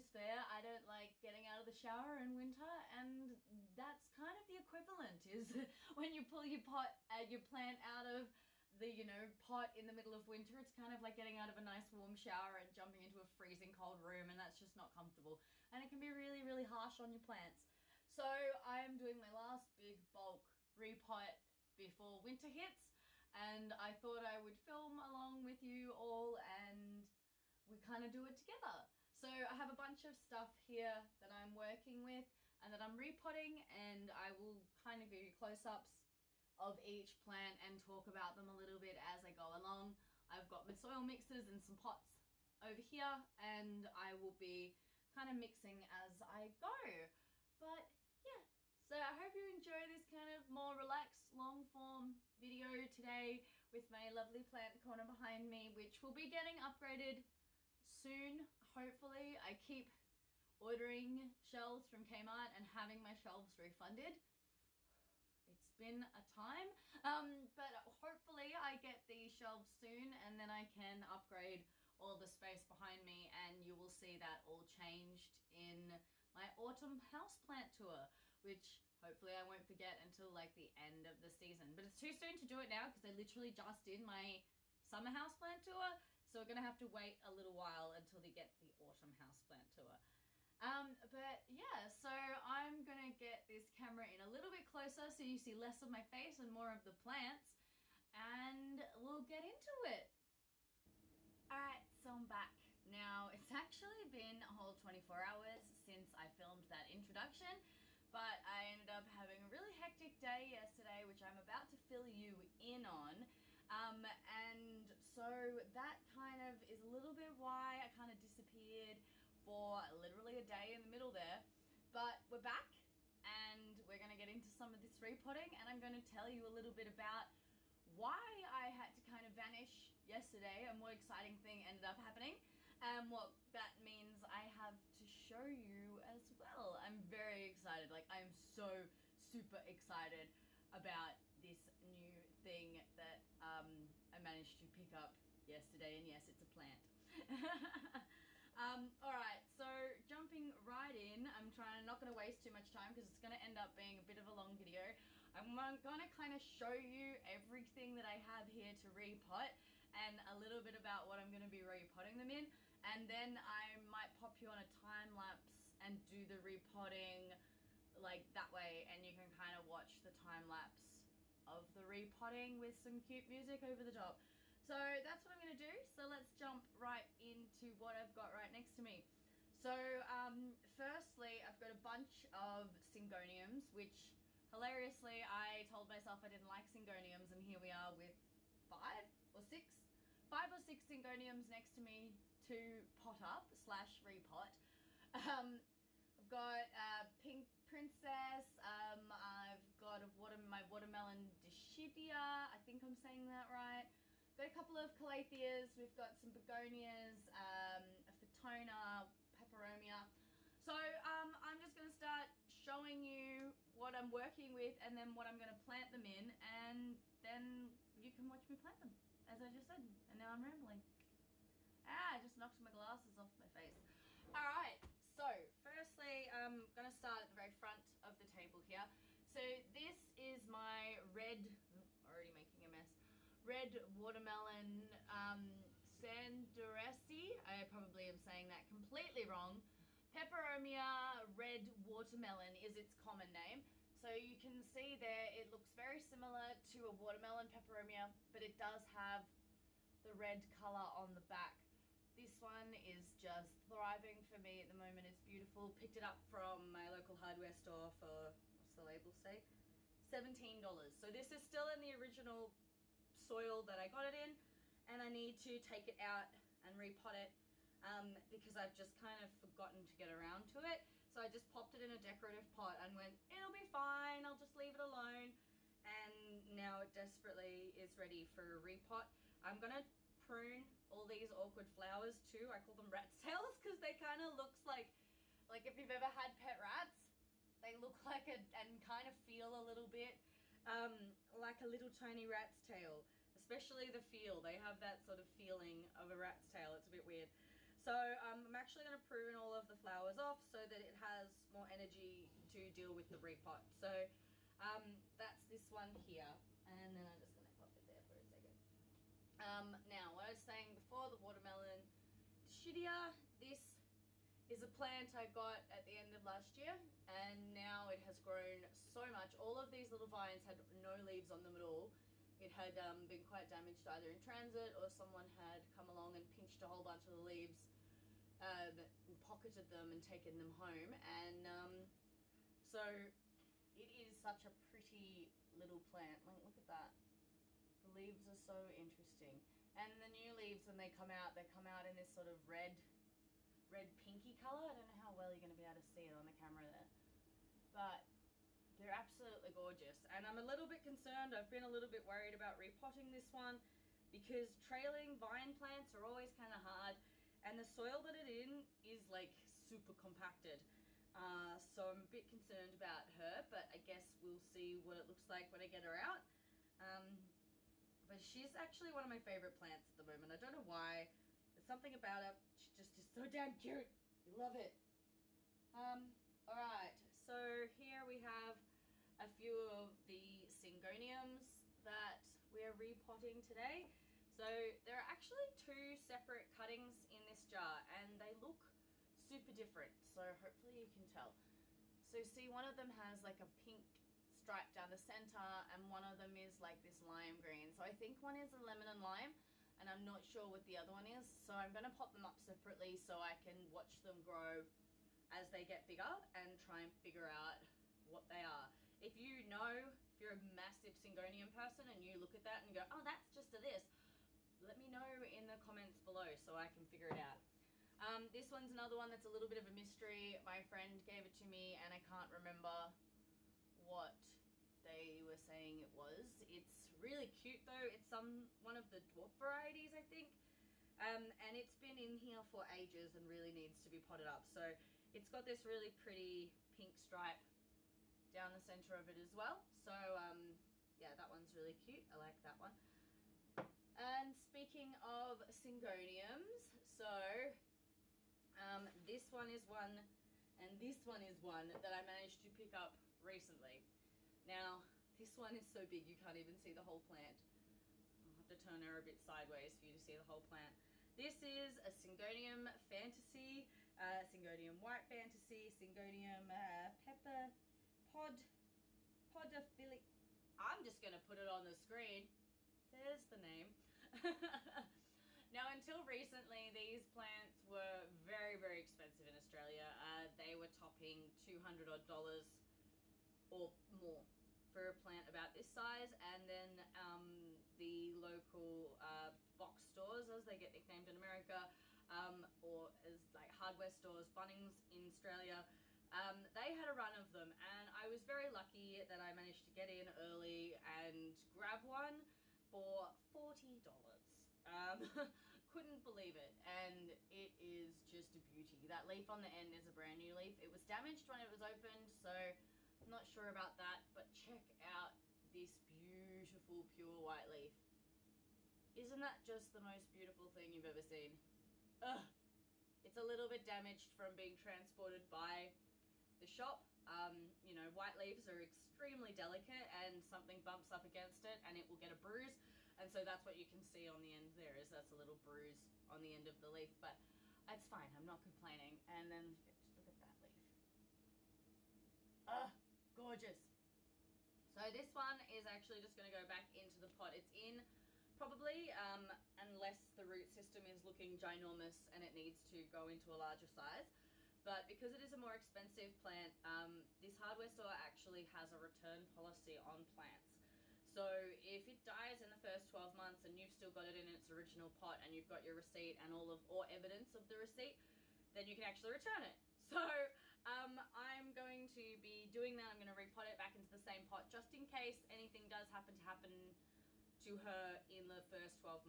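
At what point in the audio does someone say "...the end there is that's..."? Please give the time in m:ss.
8:54.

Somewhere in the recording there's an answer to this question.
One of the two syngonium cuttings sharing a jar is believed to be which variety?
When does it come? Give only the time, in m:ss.
6:38.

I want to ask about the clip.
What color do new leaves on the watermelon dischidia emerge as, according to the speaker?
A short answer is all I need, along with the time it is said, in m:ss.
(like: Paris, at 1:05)
red pinky, at 5:42.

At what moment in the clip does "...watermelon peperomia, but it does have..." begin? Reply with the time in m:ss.
4:06.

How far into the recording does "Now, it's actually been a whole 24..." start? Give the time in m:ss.
1:42.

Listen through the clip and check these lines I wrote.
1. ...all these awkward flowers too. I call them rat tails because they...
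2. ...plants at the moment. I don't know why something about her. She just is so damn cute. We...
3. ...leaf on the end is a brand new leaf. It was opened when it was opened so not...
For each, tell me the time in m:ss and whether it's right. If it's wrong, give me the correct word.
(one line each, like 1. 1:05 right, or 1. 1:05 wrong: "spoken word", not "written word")
1. 4:40 right
2. 6:09 right
3. 8:29 wrong: "damaged", not "opened".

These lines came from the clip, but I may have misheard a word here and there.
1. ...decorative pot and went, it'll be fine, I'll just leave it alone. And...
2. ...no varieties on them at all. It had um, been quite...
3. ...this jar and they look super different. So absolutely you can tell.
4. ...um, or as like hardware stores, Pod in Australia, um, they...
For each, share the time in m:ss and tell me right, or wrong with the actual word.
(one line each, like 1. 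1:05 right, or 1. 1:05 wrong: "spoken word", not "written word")
1. 4:31 right
2. 5:20 wrong: "leaves", not "varieties"
3. 6:27 wrong: "hopefully", not "absolutely"
4. 8:12 wrong: "Bunnings", not "Pod".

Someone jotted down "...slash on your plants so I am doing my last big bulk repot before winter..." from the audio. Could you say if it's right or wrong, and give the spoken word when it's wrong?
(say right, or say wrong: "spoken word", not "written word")
wrong: "harsh", not "slash".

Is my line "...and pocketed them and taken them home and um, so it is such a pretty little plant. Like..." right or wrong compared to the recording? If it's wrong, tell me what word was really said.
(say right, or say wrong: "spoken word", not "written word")
right.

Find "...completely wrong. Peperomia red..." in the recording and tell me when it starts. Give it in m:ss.
3:58.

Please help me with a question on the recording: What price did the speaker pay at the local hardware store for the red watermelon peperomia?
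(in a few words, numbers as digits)
$17.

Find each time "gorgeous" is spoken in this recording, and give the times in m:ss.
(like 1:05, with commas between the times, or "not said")
5:49, 9:03.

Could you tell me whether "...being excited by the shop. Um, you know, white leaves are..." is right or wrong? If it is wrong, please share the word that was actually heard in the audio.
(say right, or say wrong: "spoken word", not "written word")
wrong: "transported", not "excited".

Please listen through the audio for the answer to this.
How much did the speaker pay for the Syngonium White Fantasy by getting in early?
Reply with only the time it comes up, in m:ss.
8:23.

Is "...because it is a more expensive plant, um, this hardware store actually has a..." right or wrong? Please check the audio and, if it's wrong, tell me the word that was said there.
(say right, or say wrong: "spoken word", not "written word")
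right.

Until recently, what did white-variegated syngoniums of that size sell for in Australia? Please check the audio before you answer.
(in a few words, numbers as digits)
200 dollars or more.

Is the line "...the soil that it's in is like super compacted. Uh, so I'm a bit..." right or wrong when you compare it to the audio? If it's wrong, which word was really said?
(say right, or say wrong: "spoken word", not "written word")
right.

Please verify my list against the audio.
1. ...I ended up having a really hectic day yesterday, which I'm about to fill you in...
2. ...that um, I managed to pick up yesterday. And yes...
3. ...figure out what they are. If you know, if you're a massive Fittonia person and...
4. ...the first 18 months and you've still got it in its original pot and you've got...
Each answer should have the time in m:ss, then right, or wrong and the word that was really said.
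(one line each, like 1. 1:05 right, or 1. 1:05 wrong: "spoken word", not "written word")
1. 1:48 right
2. 2:22 right
3. 6:47 wrong: "Syngonium", not "Fittonia"
4. 9:22 wrong: "12", not "18".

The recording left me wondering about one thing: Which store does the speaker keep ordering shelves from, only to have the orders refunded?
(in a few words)
Kmart.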